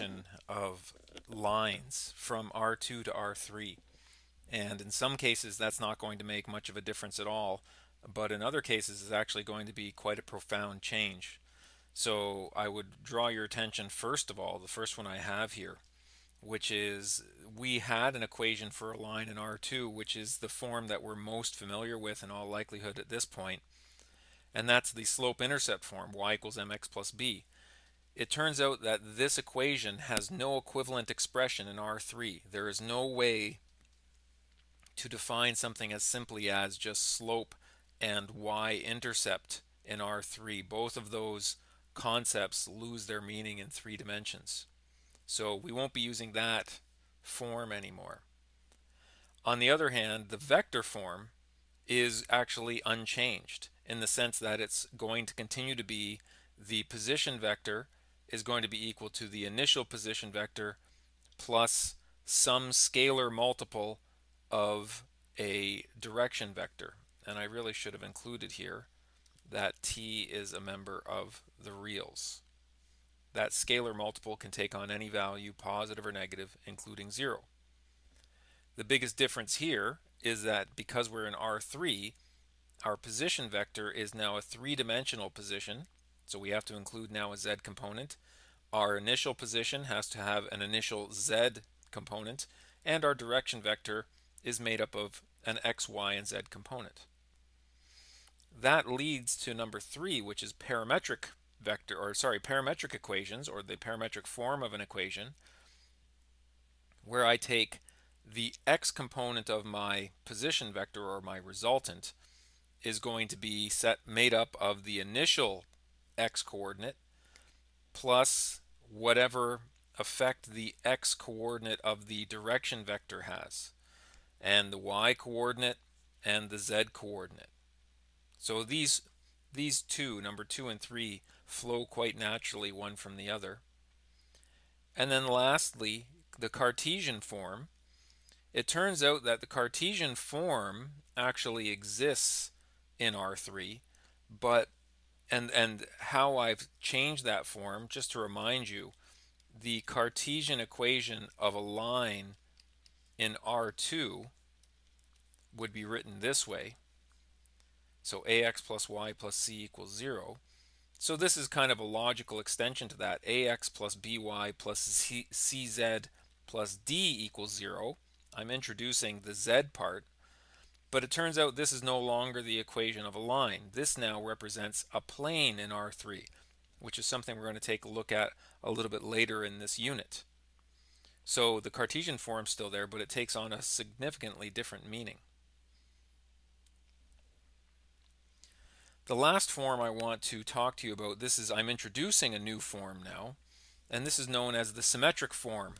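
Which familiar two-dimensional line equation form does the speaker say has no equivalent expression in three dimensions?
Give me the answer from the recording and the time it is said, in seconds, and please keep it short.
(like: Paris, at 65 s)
slope-intercept form, at 25 s.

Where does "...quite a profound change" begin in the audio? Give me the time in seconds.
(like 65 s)
9 s.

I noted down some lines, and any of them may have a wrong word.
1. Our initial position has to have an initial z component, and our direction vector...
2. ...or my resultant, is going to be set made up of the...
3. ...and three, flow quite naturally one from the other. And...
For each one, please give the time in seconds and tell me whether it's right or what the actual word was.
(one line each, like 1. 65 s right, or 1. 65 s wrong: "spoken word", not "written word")
1. 88 s right
2. 111 s right
3. 130 s right.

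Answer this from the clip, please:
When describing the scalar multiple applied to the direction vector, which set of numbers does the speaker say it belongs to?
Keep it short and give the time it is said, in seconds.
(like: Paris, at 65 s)
the reals, at 70 s.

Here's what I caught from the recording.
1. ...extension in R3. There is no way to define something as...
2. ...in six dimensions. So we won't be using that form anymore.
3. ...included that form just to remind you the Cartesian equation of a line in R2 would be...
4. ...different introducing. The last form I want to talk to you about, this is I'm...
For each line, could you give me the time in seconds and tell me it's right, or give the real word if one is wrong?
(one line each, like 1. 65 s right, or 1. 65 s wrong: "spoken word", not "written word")
1. 31 s wrong: "expression", not "extension"
2. 43 s wrong: "three", not "six"
3. 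146 s wrong: "changed", not "included"
4. 184 s wrong: "meaning", not "introducing".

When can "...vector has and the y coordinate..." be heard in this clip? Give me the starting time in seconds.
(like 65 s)
122 s.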